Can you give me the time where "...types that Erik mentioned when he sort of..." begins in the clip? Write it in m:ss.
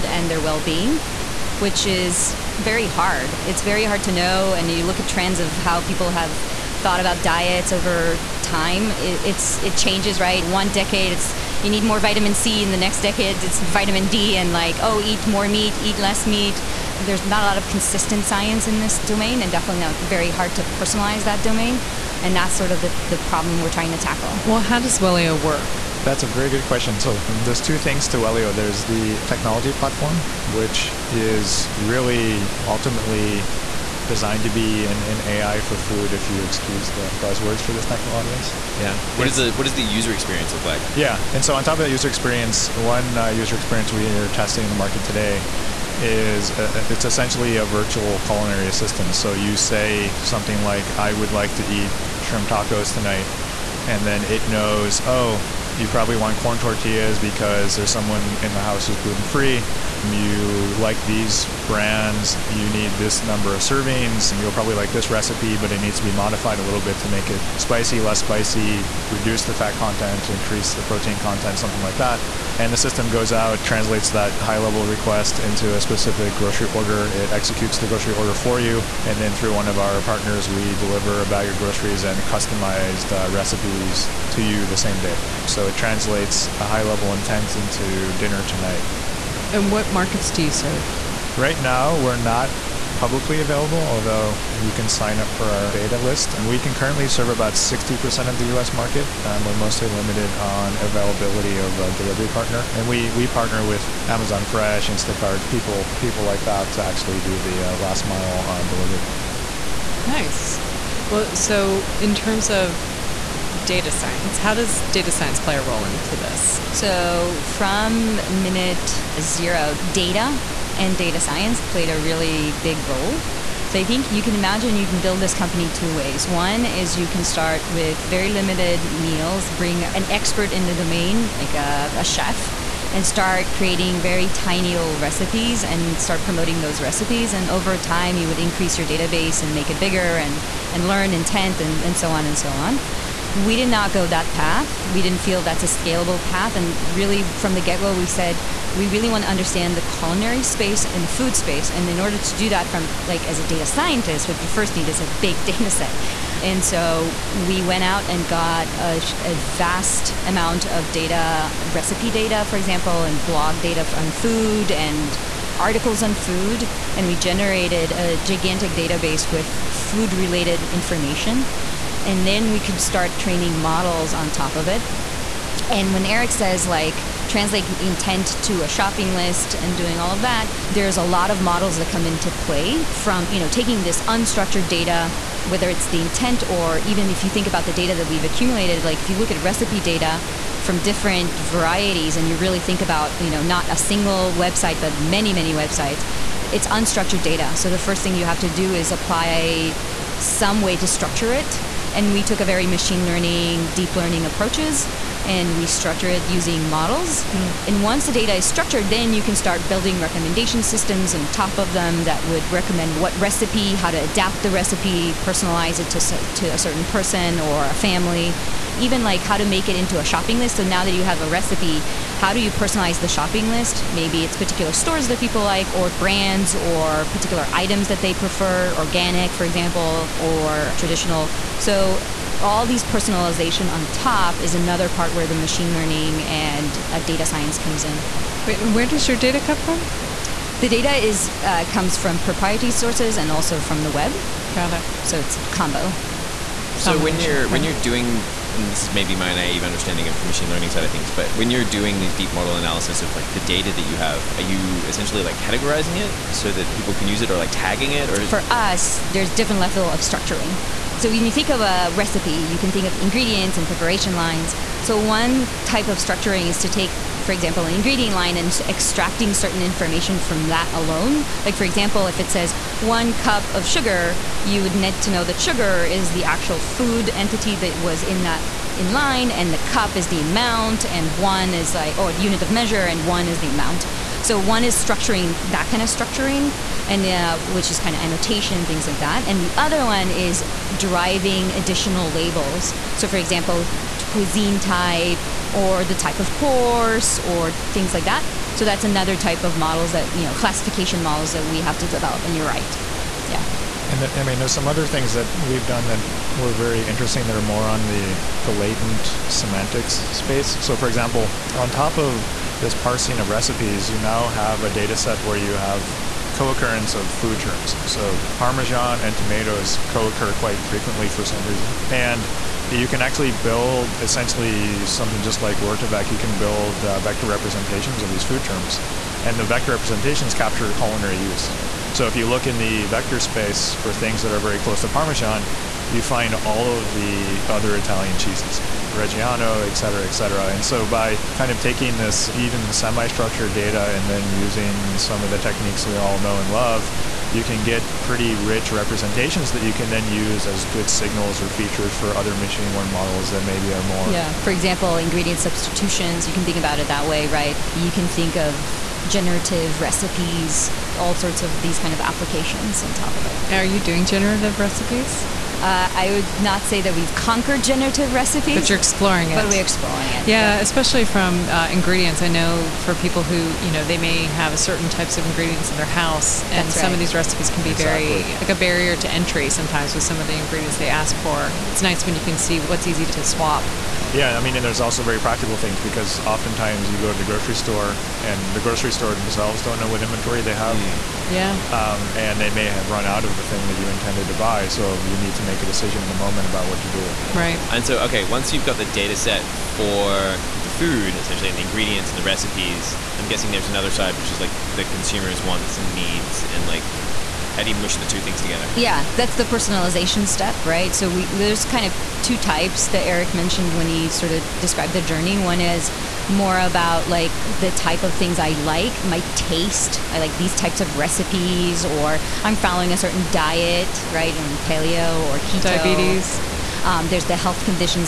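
6:52.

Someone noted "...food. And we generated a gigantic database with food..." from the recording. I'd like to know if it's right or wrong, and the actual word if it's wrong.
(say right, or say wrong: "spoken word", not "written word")
right.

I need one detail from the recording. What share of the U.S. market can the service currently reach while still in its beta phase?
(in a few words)
60%.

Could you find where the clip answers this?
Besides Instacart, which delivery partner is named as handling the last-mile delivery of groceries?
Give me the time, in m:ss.
1:44.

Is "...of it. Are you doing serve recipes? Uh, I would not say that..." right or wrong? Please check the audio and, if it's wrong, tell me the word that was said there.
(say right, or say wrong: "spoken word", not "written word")
wrong: "generative", not "serve".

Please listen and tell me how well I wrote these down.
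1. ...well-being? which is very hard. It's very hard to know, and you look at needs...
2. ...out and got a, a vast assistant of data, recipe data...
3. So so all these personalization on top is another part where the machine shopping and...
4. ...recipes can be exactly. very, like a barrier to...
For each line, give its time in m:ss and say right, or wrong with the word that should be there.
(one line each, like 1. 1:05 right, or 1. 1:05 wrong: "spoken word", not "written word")
1. 0:00 wrong: "trends", not "needs"
2. 2:37 wrong: "amount", not "assistant"
3. 3:51 wrong: "learning", not "shopping"
4. 6:17 right.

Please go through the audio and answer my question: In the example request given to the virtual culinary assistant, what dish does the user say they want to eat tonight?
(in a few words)
Shrimp tacos.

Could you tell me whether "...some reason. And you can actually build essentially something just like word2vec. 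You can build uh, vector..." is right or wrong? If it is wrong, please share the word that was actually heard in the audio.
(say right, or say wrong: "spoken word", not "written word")
right.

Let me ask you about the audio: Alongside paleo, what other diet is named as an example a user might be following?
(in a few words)
Keto.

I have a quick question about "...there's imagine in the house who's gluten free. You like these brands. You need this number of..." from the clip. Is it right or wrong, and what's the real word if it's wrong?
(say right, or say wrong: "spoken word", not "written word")
wrong: "someone", not "imagine".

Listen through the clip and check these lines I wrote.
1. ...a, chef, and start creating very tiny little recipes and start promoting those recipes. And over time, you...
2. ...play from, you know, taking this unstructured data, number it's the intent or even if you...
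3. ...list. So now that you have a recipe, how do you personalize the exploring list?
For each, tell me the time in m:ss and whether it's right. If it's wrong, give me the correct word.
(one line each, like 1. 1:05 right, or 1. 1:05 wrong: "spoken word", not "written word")
1. 2:11 right
2. 3:02 wrong: "whether", not "number"
3. 3:40 wrong: "shopping", not "exploring".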